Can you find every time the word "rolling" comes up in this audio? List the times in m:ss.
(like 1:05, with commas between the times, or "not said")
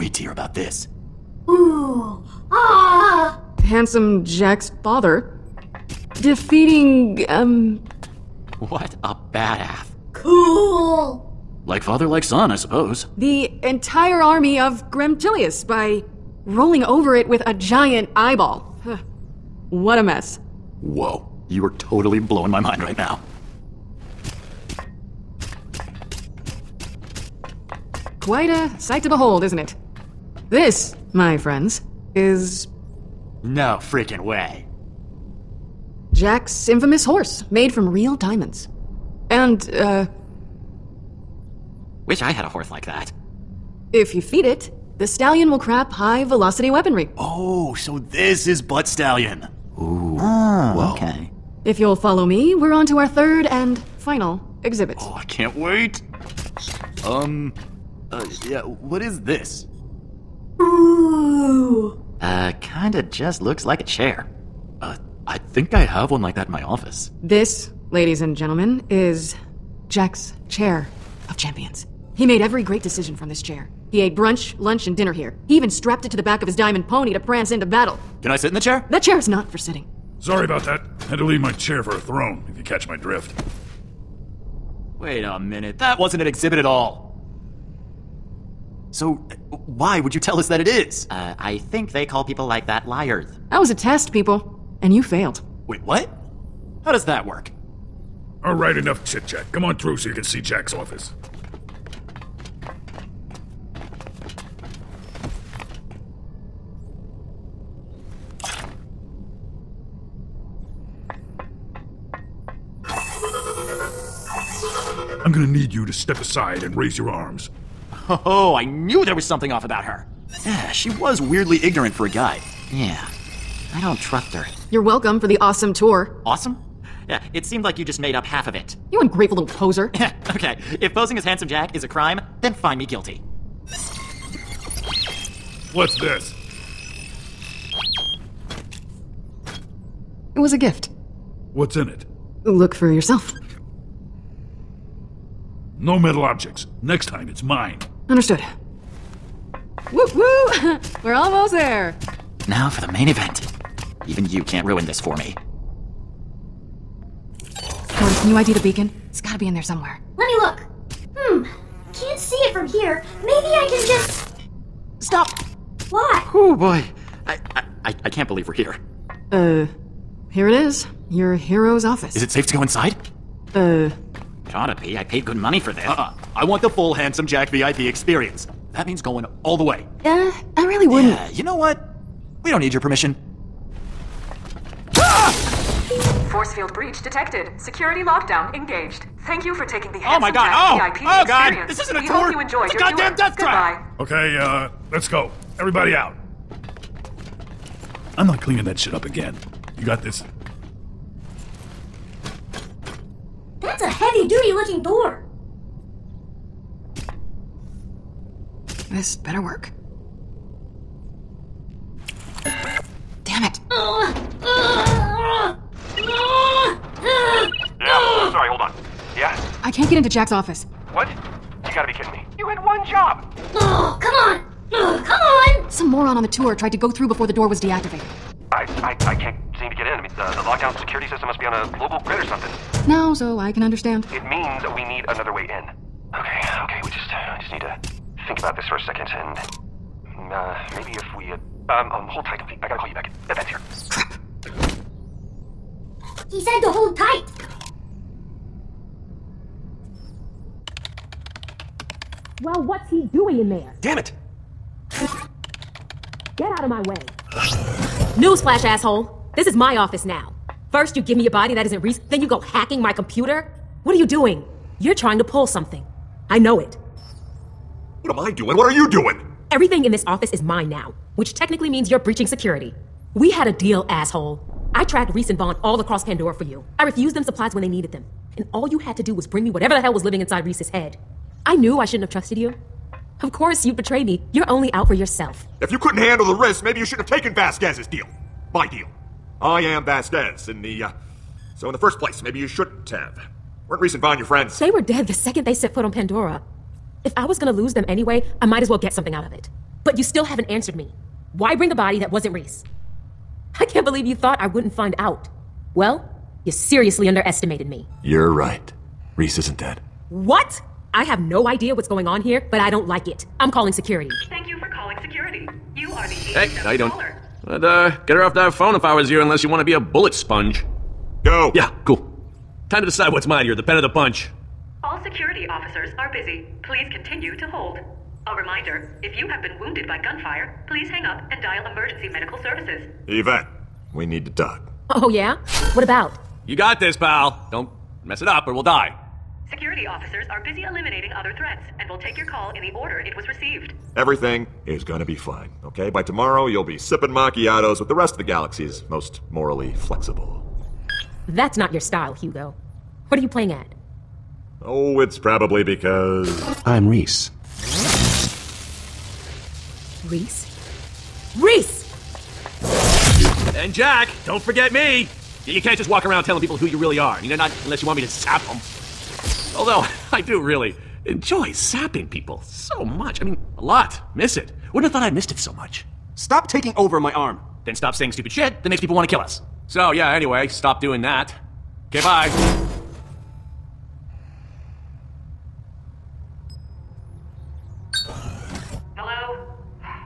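0:16.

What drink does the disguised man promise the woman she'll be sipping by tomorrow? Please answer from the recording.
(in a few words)
Macchiatos.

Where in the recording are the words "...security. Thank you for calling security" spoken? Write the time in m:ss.
5:13.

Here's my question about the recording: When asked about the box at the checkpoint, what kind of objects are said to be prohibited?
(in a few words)
Metal objects.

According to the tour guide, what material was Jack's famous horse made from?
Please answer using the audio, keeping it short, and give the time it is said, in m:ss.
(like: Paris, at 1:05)
Real diamonds, at 0:37.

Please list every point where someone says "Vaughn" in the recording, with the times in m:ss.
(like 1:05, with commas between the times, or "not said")
4:35, 4:54.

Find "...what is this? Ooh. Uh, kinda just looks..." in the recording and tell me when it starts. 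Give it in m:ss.
0:58.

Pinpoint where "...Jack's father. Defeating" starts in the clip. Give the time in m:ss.
0:04.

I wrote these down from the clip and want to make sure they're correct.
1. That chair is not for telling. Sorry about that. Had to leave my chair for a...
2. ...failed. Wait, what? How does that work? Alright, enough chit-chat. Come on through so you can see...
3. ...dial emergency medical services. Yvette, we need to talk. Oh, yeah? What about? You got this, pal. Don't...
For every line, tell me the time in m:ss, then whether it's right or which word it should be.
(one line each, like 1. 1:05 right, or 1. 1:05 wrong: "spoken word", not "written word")
1. 1:18 wrong: "sitting", not "telling"
2. 1:35 right
3. 5:31 right.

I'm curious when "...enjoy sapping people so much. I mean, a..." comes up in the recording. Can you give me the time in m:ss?
6:11.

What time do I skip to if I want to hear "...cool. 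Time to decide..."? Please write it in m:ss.
5:21.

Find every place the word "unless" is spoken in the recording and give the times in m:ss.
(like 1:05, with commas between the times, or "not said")
5:19, 6:07.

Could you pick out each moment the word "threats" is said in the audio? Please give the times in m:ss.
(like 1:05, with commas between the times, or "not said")
5:41.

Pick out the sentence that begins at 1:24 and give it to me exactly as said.
Wait a minute, that wasn't an exhibit at all.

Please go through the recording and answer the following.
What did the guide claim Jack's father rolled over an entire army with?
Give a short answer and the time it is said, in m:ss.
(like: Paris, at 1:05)
A giant eyeball, at 0:17.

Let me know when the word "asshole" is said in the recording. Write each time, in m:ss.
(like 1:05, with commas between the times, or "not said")
4:18, 4:33.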